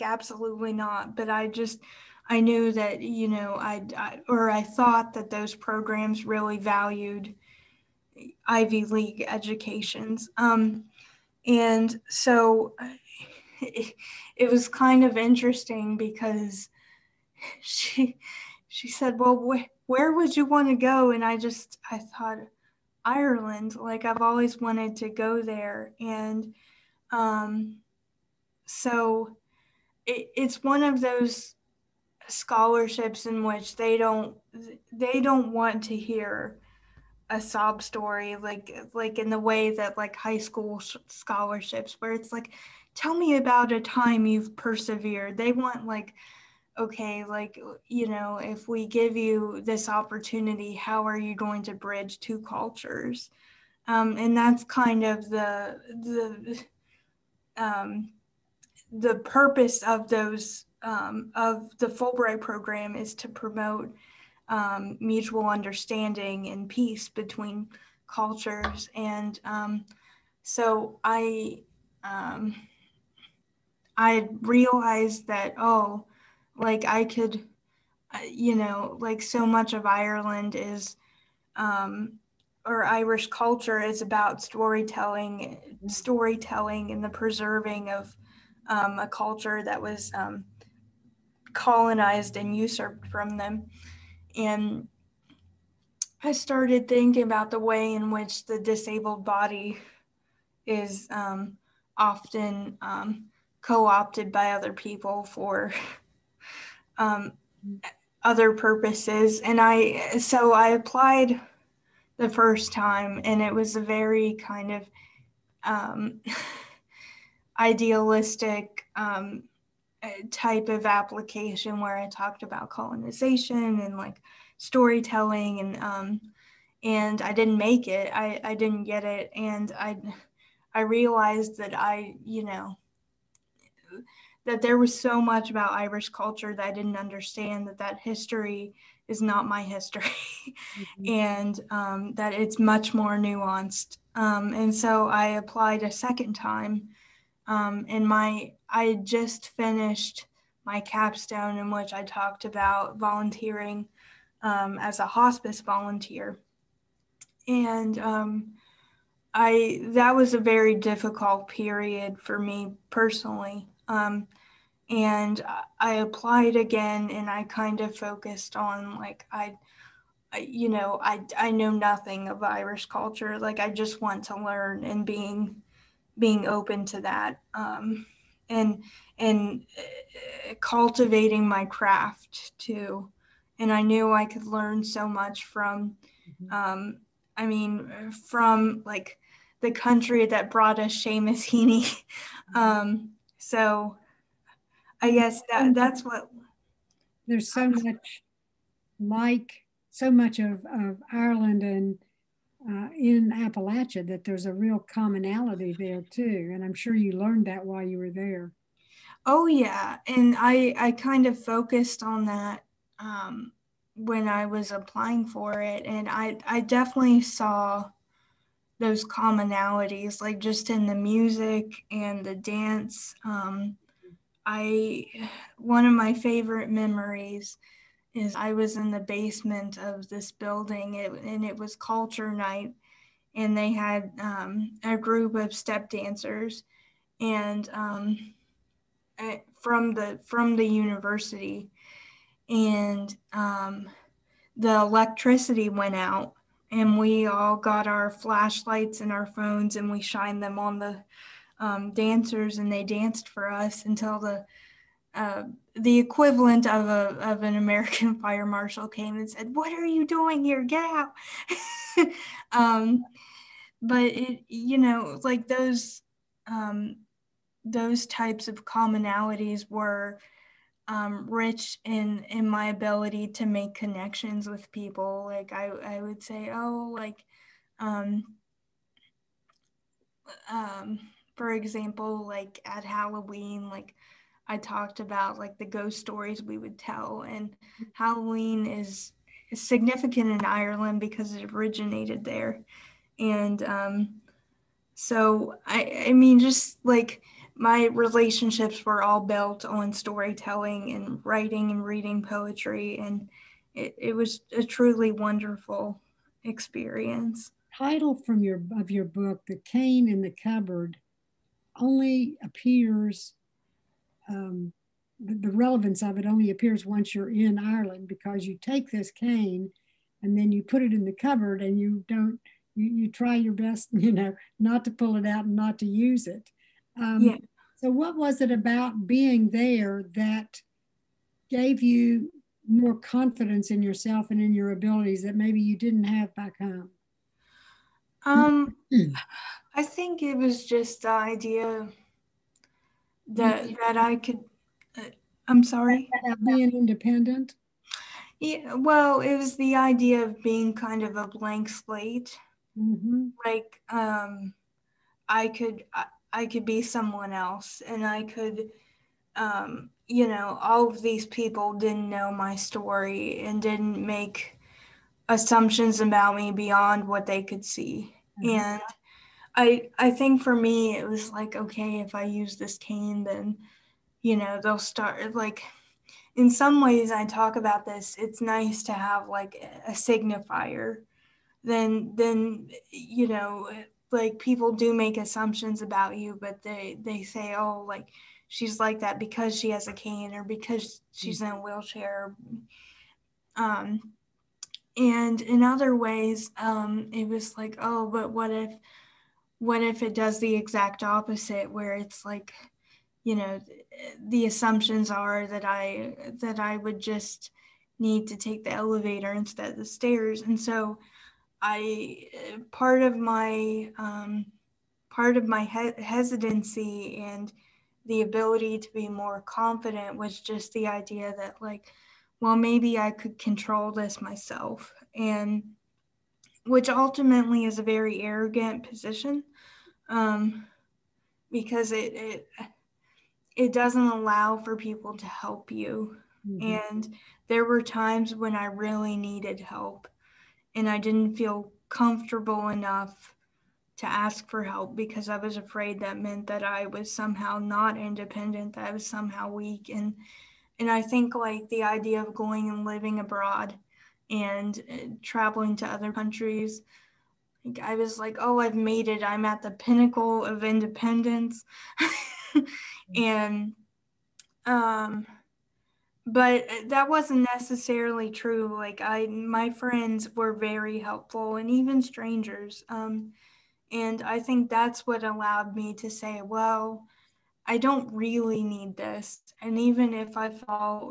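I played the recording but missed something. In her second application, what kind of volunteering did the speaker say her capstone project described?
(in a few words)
hospice volunteer.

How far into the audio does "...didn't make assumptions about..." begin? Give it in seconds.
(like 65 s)
363 s.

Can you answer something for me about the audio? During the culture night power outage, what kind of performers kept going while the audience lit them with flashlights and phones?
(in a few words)
step dancers.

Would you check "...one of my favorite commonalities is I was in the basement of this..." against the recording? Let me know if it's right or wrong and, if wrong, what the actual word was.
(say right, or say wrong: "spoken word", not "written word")
wrong: "memories", not "commonalities".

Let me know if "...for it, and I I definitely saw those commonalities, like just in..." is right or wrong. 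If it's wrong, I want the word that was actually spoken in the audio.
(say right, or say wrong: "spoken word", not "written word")
right.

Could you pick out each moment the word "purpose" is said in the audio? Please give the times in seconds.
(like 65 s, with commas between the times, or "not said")
59 s, 108 s.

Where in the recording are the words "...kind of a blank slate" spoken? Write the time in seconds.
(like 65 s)
350 s.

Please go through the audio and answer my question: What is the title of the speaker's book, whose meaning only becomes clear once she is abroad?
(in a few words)
The Cane in the Cupboard.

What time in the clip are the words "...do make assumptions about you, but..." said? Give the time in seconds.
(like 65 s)
384 s.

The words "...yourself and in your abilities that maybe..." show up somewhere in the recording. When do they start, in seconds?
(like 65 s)
333 s.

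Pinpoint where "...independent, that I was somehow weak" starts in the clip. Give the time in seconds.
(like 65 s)
447 s.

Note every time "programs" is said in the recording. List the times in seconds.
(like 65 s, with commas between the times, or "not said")
5 s, 62 s.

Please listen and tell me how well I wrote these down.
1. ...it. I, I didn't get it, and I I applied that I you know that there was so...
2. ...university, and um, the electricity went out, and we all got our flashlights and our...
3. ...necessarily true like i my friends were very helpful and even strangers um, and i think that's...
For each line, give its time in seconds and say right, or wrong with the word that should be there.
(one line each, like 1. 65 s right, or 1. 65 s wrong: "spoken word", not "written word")
1. 127 s wrong: "realized", not "applied"
2. 240 s right
3. 467 s right.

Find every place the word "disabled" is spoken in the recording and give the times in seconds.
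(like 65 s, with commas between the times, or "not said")
98 s.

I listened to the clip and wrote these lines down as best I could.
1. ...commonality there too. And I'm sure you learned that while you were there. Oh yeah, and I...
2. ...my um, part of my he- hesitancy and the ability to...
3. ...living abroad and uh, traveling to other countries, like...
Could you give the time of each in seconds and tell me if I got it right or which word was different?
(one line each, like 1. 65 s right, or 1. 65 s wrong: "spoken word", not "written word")
1. 204 s right
2. 413 s right
3. 452 s right.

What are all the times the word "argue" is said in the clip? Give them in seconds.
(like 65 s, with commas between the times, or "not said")
not said.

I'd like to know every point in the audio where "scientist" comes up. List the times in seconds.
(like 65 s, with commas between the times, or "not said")
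not said.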